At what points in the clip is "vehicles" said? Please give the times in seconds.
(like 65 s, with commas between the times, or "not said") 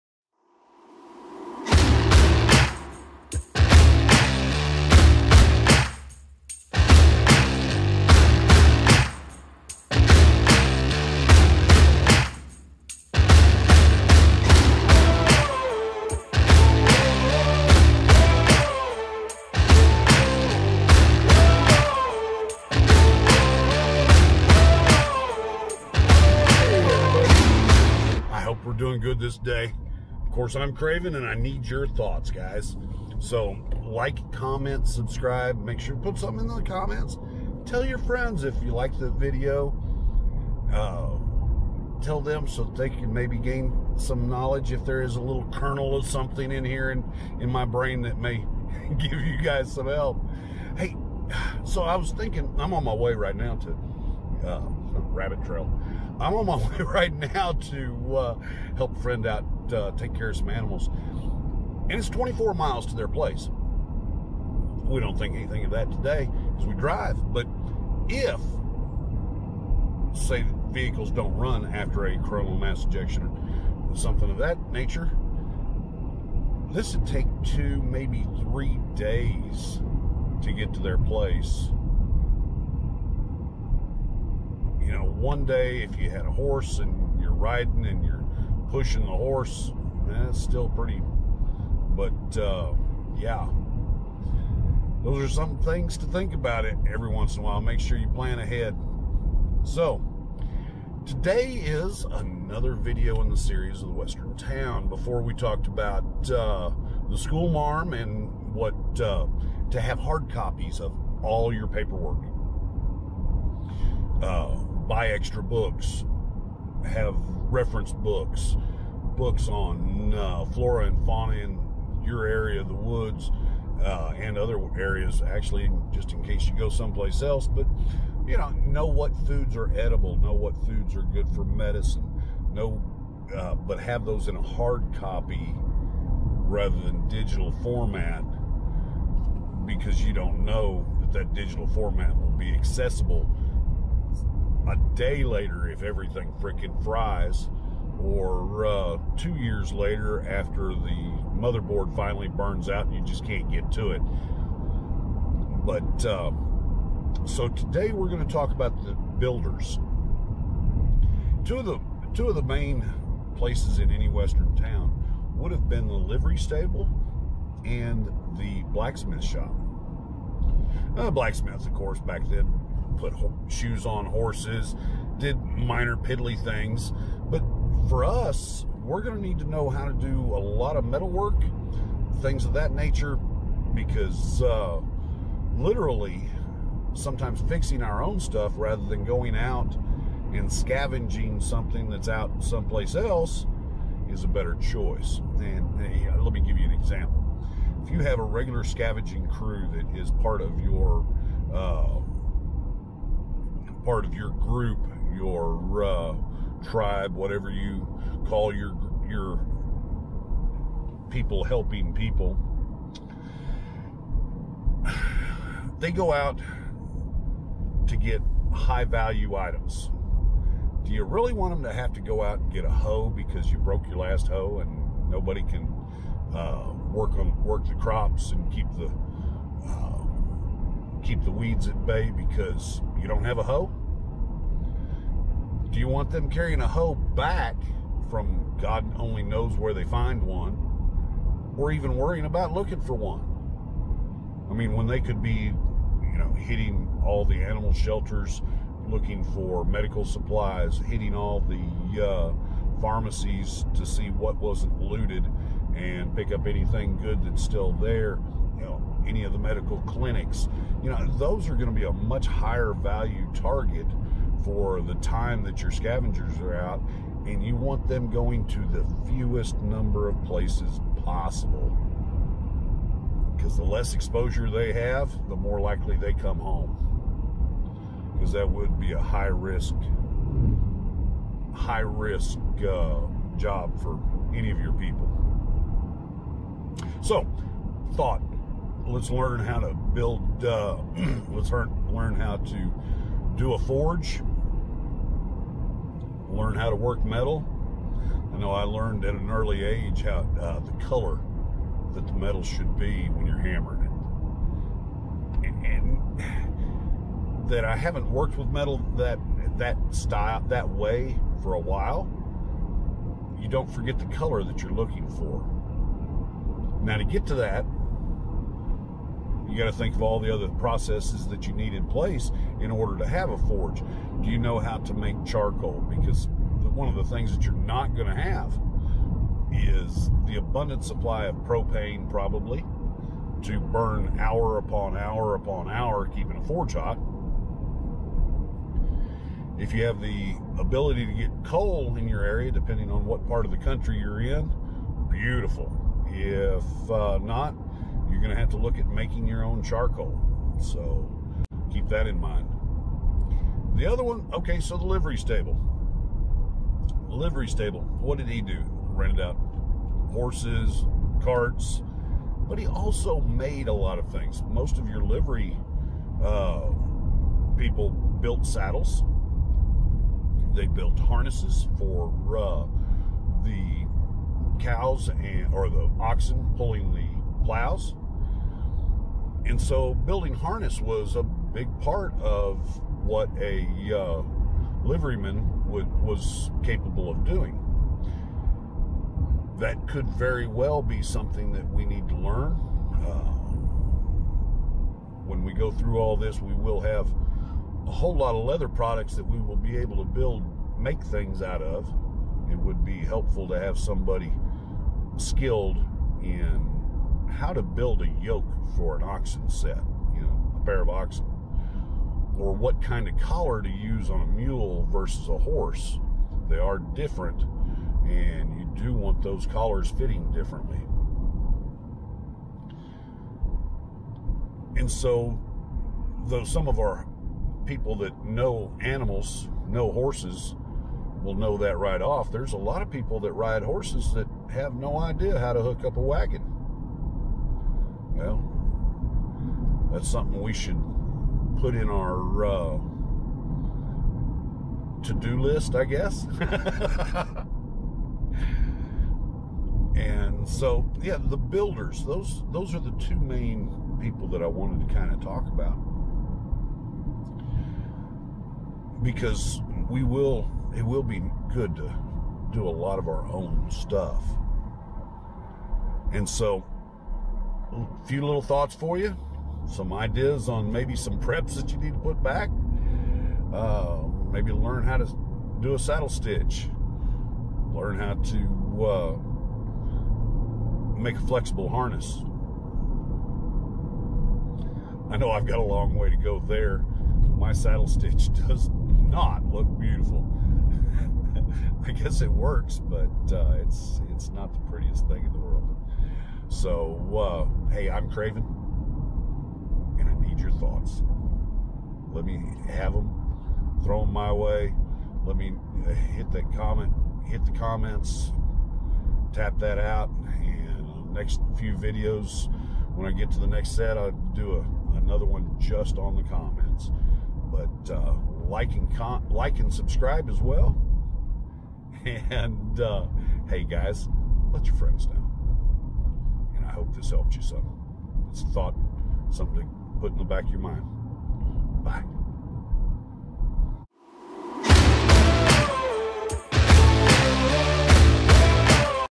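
70 s.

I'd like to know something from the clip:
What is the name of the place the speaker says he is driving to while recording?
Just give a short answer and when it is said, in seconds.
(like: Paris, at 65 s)
Rabbit Trail, at 55 s.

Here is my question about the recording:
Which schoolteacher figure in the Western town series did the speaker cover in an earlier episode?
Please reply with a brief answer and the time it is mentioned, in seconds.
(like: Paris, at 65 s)
School marm, at 107 s.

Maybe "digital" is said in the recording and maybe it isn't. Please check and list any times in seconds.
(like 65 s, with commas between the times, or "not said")
137 s, 141 s.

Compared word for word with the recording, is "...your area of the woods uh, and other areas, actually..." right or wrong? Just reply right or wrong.
right.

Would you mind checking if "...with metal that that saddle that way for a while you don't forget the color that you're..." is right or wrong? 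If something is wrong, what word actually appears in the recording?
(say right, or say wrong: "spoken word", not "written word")
wrong: "style", not "saddle".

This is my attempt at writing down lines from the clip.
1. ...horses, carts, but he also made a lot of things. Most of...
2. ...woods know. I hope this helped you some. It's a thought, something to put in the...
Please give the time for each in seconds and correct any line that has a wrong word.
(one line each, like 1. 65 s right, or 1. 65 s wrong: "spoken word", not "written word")
1. 360 s right
2. 524 s wrong: "friends", not "woods".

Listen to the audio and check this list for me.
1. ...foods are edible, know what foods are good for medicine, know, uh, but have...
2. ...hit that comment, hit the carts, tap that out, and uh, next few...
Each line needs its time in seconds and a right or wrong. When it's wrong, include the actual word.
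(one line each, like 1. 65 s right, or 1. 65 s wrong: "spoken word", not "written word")
1. 129 s right
2. 505 s wrong: "comments", not "carts".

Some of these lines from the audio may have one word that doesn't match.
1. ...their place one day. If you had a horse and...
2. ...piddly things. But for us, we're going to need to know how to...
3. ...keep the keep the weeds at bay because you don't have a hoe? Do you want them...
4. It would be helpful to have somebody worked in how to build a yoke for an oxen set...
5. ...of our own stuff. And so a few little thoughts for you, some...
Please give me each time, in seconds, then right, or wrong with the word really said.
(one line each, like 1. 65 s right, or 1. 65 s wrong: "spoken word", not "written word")
1. 80 s right
2. 175 s right
3. 228 s right
4. 402 s wrong: "skilled", not "worked"
5. 462 s right.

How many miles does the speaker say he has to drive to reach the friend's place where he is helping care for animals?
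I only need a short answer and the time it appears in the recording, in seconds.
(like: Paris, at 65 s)
24, at 62 s.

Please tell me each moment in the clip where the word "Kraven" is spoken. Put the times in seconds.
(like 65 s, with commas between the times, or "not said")
30 s, 498 s.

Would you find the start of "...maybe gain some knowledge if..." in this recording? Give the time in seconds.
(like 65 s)
43 s.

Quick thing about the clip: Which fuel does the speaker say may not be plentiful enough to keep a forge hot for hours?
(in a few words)
Propane.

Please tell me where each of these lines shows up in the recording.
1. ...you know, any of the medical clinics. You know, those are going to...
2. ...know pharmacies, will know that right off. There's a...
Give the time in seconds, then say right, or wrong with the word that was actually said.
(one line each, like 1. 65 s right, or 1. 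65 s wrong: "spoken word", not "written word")
1. 258 s right
2. 429 s wrong: "horses", not "pharmacies".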